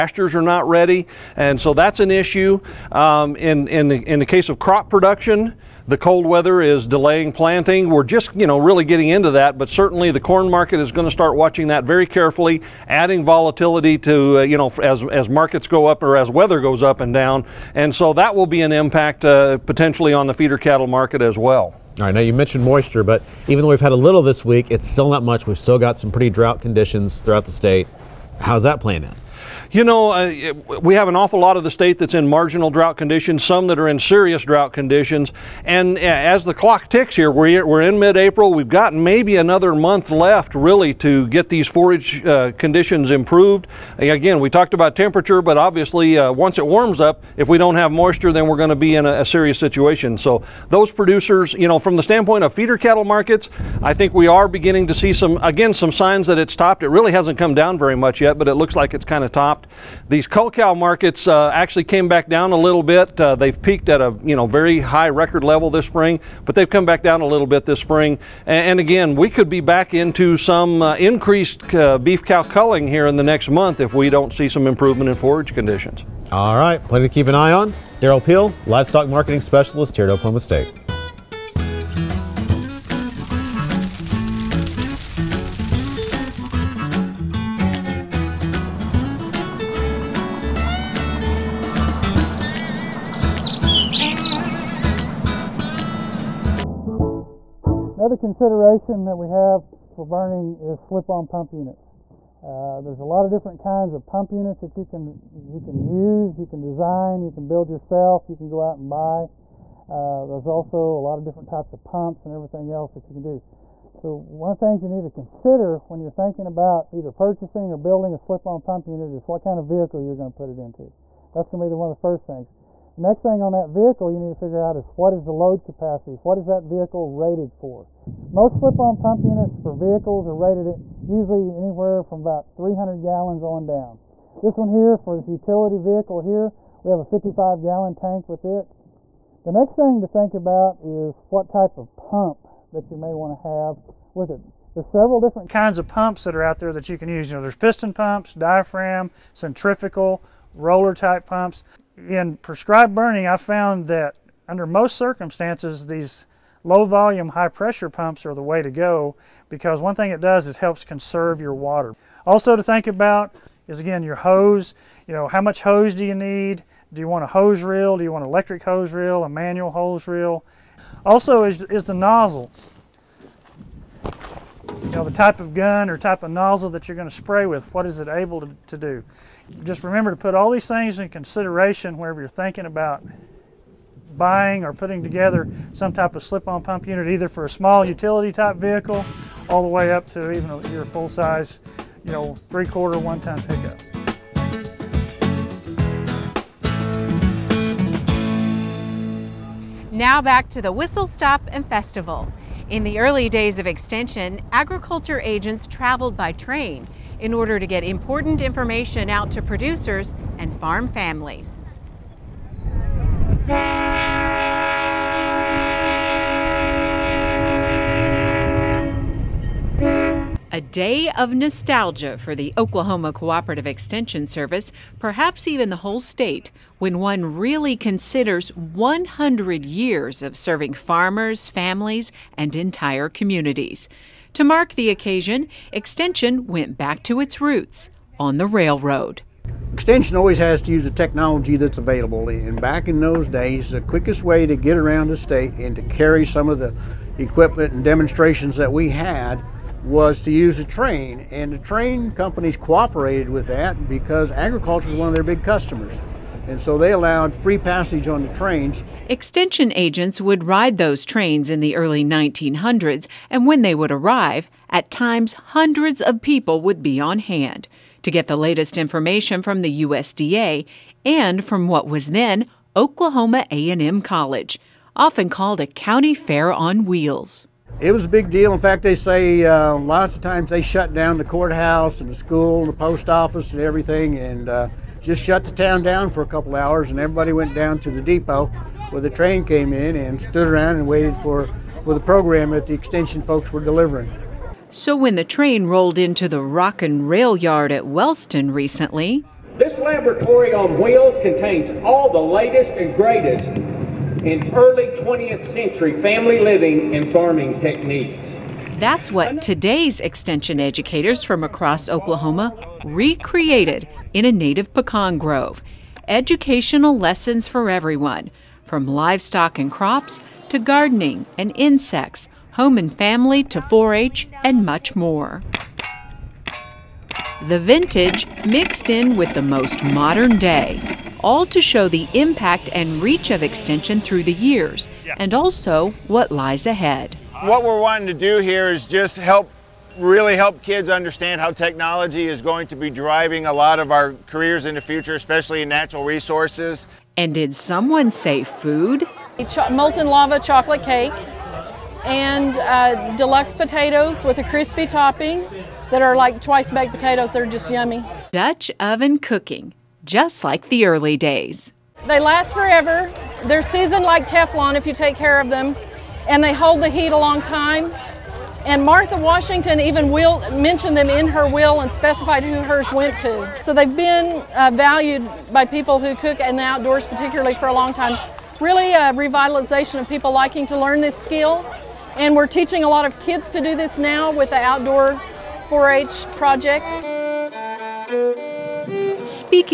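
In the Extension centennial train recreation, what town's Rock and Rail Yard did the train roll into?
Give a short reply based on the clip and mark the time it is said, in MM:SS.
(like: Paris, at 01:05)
Wellston, at 04:57.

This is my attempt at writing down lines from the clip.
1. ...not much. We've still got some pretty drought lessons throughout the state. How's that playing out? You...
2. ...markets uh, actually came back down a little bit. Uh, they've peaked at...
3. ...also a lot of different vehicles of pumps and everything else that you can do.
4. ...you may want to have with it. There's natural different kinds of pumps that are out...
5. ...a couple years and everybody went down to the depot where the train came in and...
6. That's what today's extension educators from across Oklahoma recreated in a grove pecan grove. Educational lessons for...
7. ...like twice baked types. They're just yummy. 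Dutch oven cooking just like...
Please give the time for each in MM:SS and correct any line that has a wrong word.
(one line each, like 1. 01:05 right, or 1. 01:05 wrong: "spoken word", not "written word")
1. 00:25 wrong: "conditions", not "lessons"
2. 01:00 right
3. 01:50 wrong: "types", not "vehicles"
4. 02:22 wrong: "several", not "natural"
5. 04:46 wrong: "hours", not "years"
6. 05:08 wrong: "native", not "grove"
7. 05:56 wrong: "potatoes", not "types".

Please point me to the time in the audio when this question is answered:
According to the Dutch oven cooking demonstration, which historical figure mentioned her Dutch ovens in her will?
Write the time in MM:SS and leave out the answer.
06:08.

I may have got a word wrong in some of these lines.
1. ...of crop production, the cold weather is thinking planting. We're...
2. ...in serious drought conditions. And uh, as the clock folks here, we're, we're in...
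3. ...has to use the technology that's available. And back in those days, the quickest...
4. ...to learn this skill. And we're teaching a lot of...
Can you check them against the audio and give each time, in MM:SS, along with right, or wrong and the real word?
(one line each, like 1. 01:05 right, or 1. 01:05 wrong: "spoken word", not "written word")
1. 00:04 wrong: "delaying", not "thinking"
2. 00:33 wrong: "ticks", not "folks"
3. 04:00 right
4. 06:20 right.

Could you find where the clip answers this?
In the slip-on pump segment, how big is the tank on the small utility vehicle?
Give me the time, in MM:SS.
02:17.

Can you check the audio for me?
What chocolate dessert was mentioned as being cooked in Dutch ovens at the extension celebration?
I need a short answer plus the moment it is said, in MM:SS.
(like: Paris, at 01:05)
Molten lava chocolate cake, at 05:49.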